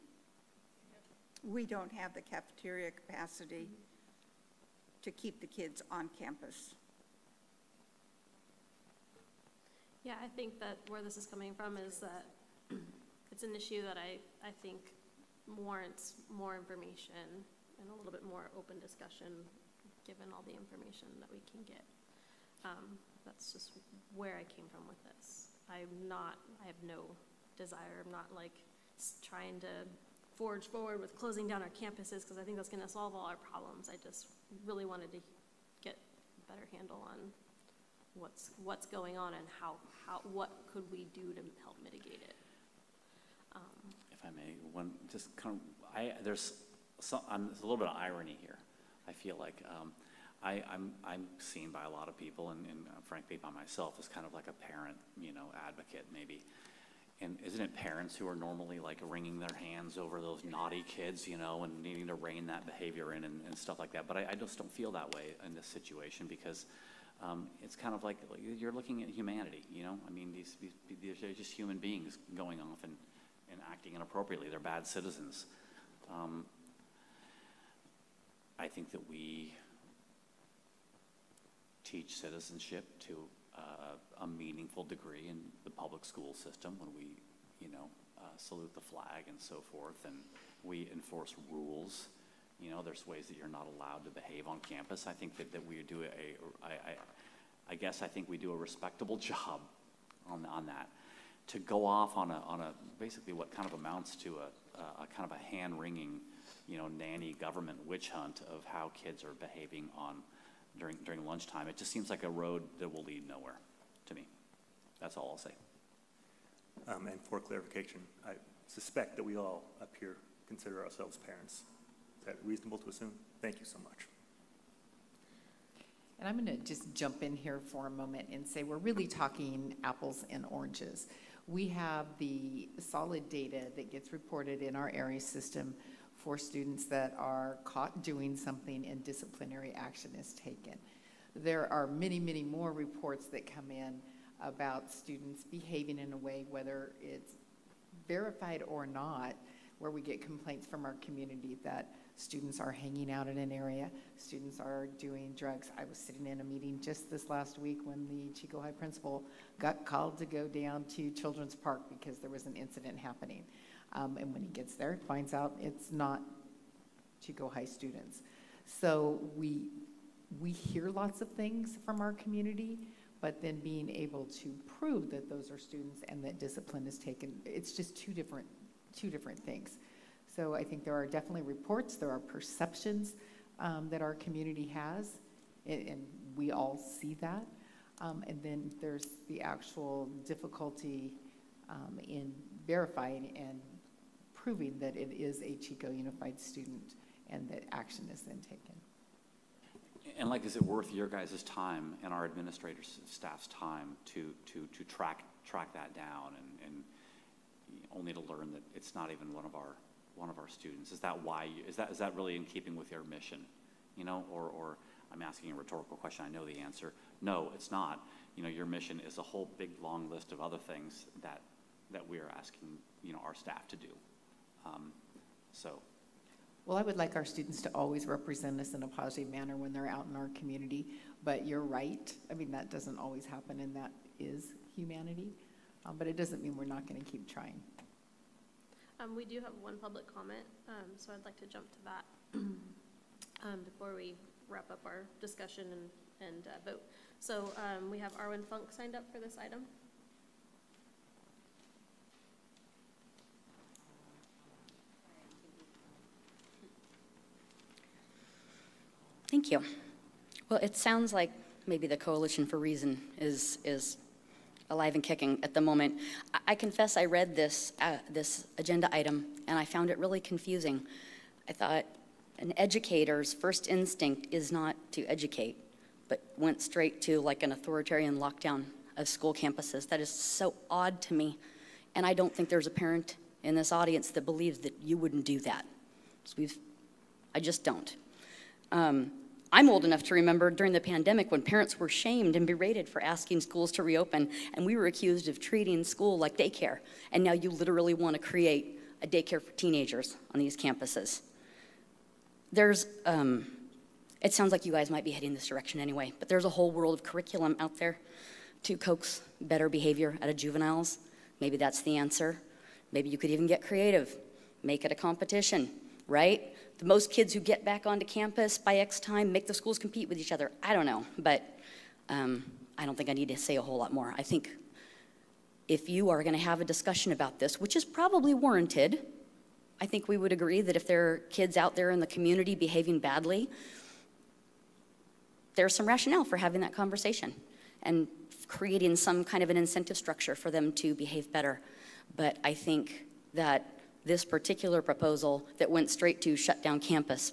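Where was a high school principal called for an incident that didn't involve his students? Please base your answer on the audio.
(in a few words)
Children's Park.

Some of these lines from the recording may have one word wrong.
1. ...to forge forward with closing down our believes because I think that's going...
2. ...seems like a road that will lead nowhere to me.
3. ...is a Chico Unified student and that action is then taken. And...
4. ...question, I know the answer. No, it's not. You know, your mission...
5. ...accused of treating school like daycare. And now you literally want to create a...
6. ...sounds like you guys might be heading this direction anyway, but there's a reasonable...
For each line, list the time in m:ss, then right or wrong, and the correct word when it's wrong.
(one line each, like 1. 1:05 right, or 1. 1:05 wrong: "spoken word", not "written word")
1. 0:29 wrong: "campuses", not "believes"
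2. 1:51 right
3. 3:15 right
4. 3:35 right
5. 4:54 right
6. 5:04 wrong: "whole", not "reasonable".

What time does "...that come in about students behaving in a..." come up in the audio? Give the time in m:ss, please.
2:23.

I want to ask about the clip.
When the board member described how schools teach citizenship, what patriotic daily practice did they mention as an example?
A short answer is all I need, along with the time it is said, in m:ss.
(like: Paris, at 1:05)
salute the flag, at 1:28.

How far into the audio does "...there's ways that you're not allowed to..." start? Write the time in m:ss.
1:32.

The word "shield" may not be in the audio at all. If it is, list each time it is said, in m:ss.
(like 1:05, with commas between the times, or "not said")
not said.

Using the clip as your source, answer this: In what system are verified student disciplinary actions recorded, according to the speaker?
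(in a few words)
Aeries.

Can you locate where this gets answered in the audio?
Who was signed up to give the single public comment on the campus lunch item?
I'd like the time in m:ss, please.
4:08.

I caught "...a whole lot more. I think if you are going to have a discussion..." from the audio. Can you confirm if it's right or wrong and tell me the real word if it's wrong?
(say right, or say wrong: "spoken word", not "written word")
right.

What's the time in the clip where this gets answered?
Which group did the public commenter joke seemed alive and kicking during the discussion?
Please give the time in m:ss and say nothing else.
4:21.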